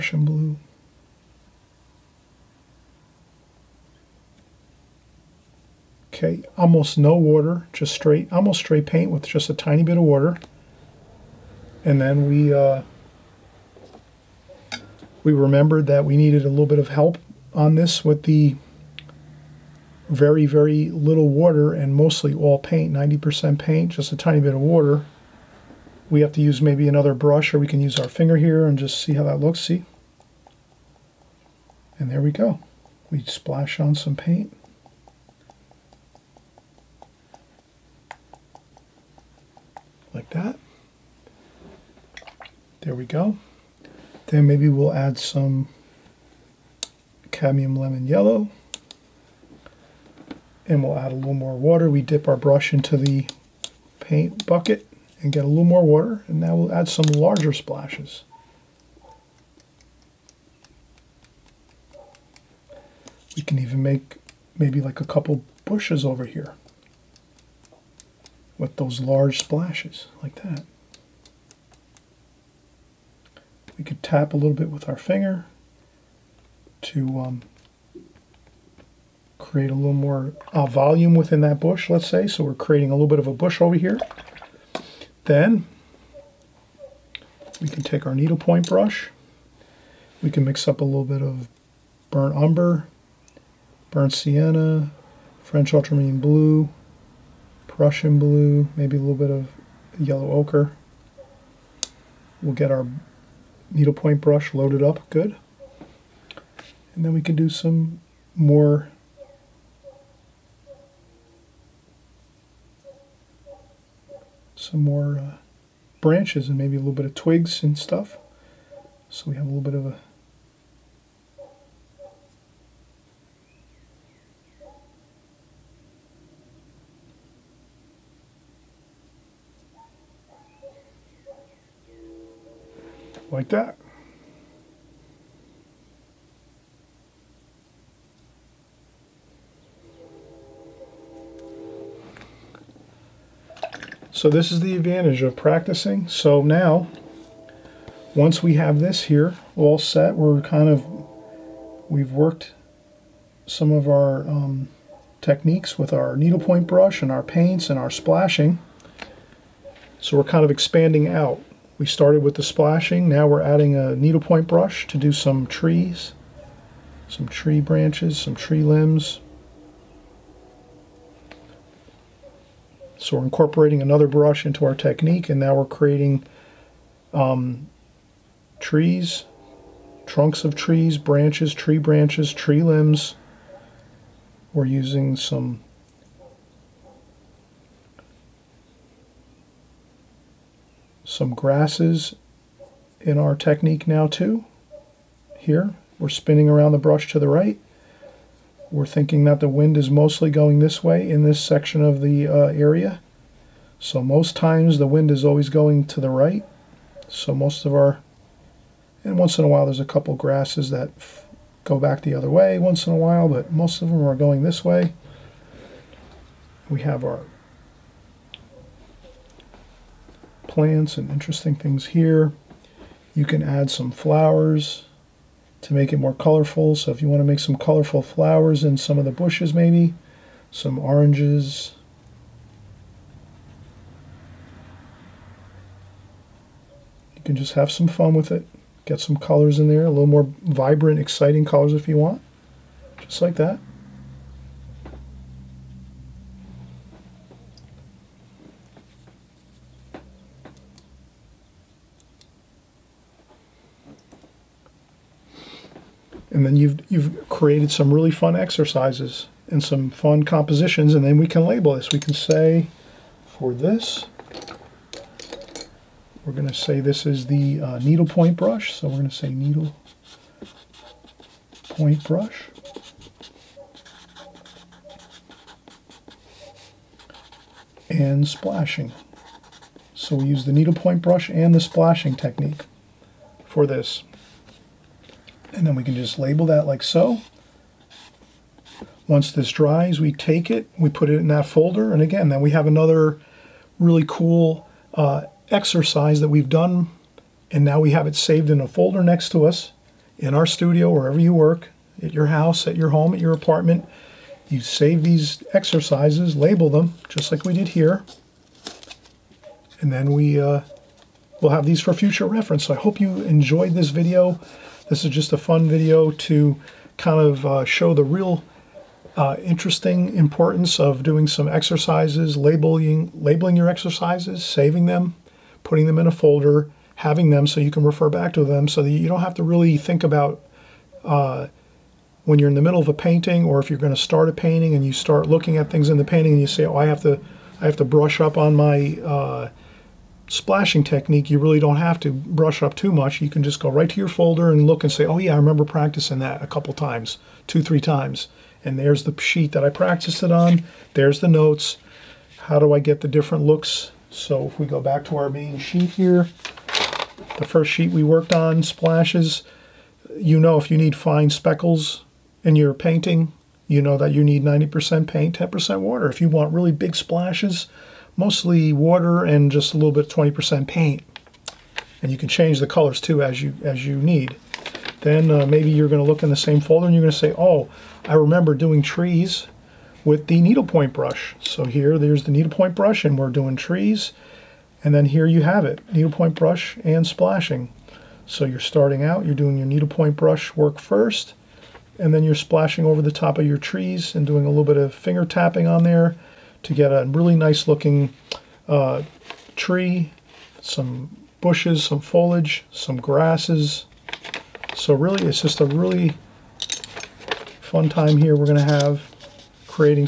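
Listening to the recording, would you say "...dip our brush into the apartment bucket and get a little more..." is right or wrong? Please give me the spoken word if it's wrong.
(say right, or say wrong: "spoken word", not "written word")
wrong: "paint", not "apartment".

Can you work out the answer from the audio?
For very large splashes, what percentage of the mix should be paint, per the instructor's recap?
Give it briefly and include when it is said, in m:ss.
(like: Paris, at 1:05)
20%, at 6:10.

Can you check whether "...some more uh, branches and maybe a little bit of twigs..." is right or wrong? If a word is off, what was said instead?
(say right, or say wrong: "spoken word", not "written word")
right.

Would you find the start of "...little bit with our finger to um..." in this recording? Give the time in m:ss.
1:14.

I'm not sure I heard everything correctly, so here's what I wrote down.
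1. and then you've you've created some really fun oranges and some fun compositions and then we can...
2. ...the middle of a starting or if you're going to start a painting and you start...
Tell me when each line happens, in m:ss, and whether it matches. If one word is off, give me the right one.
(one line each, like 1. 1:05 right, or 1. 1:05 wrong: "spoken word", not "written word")
1. 4:16 wrong: "exercises", not "oranges"
2. 5:32 wrong: "painting", not "starting".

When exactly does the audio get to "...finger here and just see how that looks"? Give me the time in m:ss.
0:28.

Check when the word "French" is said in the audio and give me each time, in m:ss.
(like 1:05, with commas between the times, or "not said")
1:35.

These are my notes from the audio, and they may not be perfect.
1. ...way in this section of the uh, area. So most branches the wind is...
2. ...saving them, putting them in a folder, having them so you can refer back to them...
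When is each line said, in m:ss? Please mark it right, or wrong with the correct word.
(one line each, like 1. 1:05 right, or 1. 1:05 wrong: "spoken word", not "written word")
1. 3:20 wrong: "times", not "branches"
2. 5:24 right.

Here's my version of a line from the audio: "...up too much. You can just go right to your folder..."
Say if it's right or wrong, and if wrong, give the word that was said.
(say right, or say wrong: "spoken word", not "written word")
right.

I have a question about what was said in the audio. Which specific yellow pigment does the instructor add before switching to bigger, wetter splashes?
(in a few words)
cadmium lemon yellow.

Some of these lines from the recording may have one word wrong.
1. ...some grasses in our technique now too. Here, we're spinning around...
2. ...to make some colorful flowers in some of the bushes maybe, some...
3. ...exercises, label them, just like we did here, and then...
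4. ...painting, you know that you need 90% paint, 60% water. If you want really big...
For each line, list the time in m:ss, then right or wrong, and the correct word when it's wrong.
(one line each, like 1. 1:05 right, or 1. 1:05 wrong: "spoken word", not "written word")
1. 3:11 right
2. 3:47 right
3. 5:05 right
4. 6:02 wrong: "10", not "60".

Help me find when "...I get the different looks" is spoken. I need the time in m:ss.
5:52.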